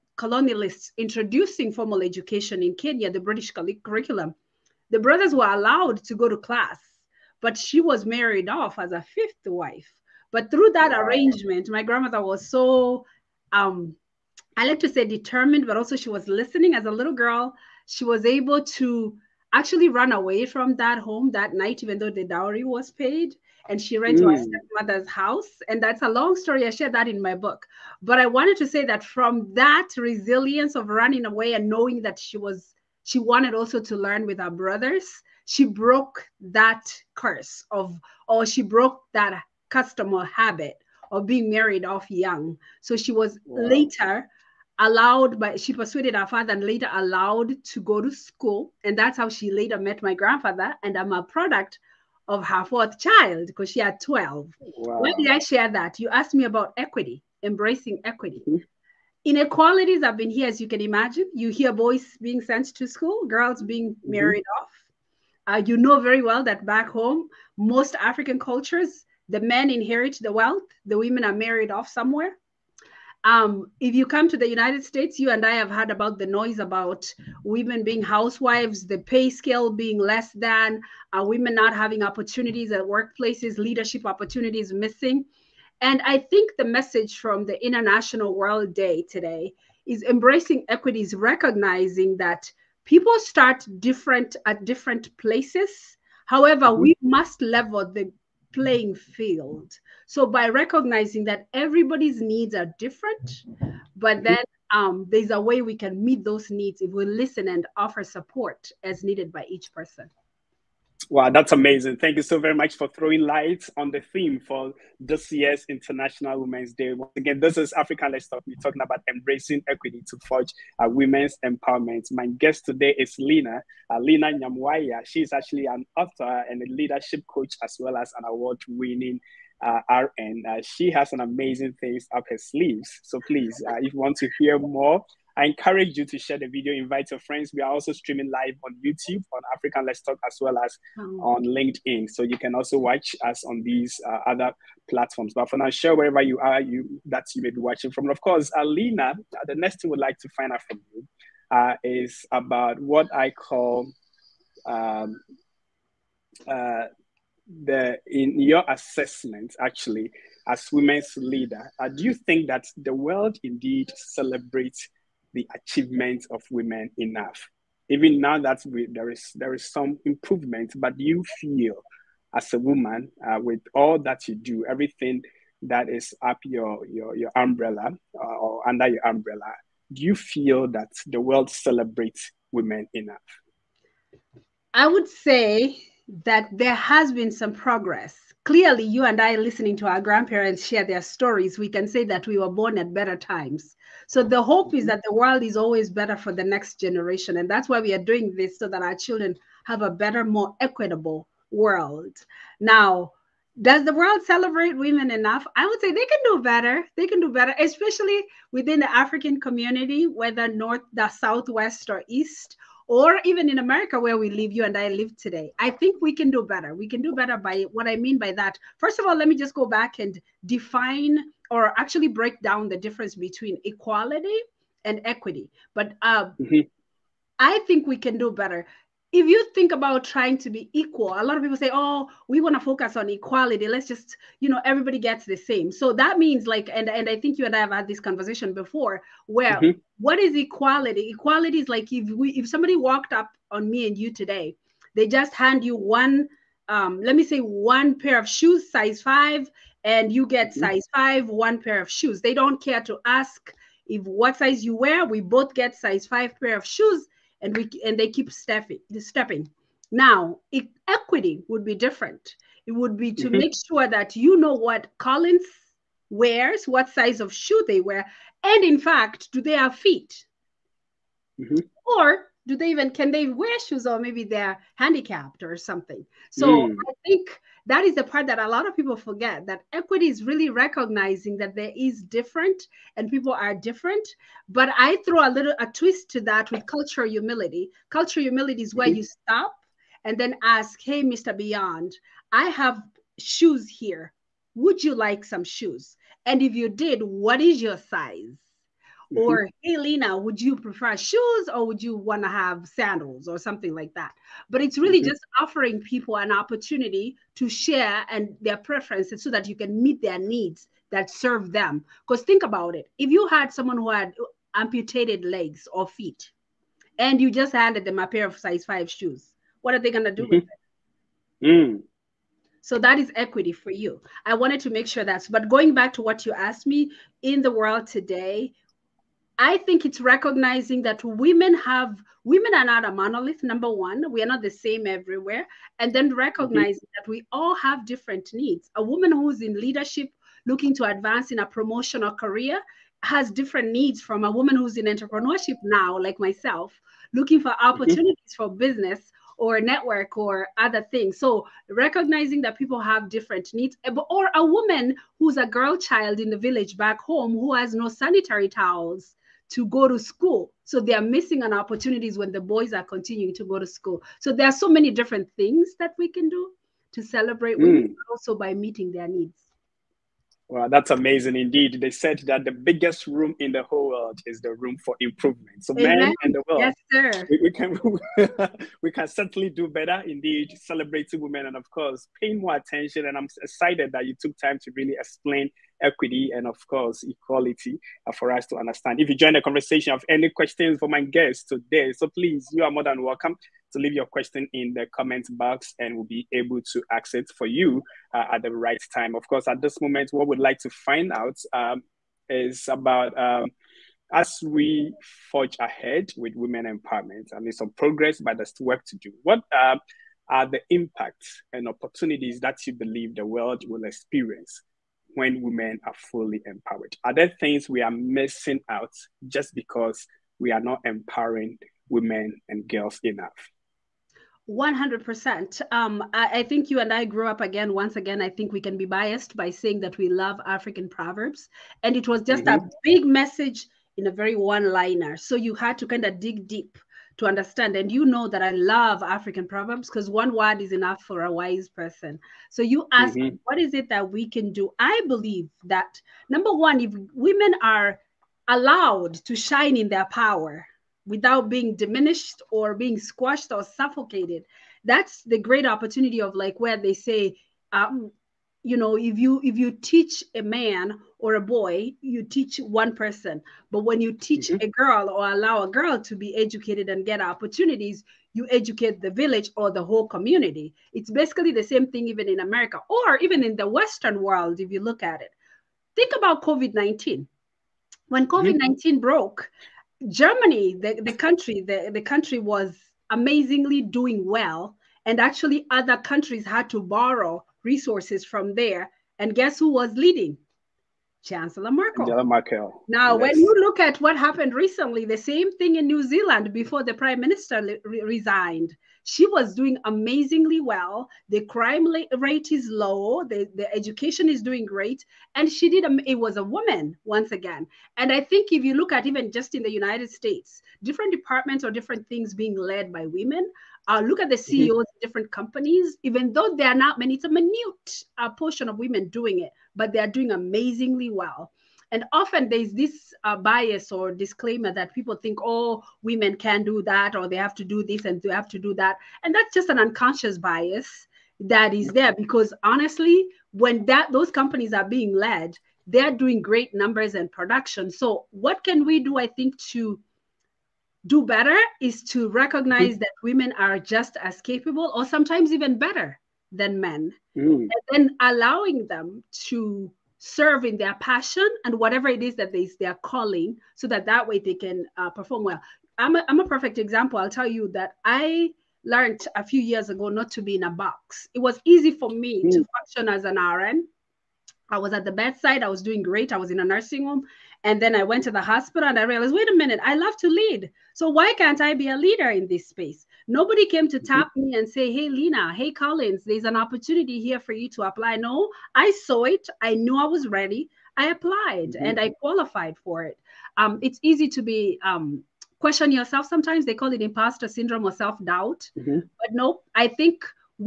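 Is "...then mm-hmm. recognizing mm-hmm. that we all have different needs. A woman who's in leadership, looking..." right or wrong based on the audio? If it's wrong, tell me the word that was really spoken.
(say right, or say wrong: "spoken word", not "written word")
right.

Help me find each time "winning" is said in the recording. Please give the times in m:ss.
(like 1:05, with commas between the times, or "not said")
2:08.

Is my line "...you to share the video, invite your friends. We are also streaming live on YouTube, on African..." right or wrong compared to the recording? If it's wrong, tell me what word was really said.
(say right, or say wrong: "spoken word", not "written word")
right.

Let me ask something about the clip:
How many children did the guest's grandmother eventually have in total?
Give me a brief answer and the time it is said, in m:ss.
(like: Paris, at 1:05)
12, at 0:54.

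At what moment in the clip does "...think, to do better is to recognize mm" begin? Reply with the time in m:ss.
8:59.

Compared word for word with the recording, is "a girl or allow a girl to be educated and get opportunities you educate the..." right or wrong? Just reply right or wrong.
right.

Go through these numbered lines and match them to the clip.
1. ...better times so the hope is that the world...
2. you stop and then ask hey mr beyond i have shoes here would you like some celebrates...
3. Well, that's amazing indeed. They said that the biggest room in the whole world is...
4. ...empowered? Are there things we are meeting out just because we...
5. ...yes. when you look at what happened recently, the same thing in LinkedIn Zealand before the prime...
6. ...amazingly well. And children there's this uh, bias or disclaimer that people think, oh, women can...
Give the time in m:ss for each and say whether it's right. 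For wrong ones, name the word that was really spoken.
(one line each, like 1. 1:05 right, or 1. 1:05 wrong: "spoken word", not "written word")
1. 3:12 right
2. 4:48 wrong: "shoes", not "celebrates"
3. 6:10 right
4. 6:56 wrong: "missing", not "meeting"
5. 8:13 wrong: "New", not "LinkedIn"
6. 8:40 wrong: "often", not "children".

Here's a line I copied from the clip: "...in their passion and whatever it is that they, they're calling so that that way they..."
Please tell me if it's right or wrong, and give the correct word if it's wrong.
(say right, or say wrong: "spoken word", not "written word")
right.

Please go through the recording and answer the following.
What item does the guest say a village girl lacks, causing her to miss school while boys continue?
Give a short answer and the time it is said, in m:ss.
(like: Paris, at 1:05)
Sanitary towels, at 5:57.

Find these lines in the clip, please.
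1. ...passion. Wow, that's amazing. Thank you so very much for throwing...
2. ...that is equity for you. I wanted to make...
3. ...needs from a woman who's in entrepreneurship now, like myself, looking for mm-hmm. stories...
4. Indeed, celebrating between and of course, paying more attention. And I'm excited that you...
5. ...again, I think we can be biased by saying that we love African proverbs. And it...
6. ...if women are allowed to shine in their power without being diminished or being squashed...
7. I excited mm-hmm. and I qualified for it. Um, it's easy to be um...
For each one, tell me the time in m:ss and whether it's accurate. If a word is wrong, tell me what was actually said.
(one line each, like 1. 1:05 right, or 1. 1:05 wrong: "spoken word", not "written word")
1. 1:49 wrong: "person", not "passion"
2. 5:22 right
3. 5:43 wrong: "opportunities", not "stories"
4. 6:20 wrong: "women", not "between"
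5. 7:07 right
6. 7:26 right
7. 9:40 wrong: "applied", not "excited".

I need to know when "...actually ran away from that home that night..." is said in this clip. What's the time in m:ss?
0:19.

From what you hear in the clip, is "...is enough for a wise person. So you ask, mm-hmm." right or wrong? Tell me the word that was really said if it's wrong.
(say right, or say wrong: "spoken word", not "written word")
right.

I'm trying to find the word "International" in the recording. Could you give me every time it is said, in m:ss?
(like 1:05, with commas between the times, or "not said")
1:27, 1:55.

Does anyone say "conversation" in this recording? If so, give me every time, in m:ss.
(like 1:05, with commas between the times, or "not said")
3:57, 6:29.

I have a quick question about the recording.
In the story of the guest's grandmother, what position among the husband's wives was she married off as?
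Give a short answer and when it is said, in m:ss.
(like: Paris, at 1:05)
Fifth wife, at 0:09.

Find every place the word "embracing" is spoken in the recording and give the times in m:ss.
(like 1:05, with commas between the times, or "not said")
0:57, 1:30, 1:59.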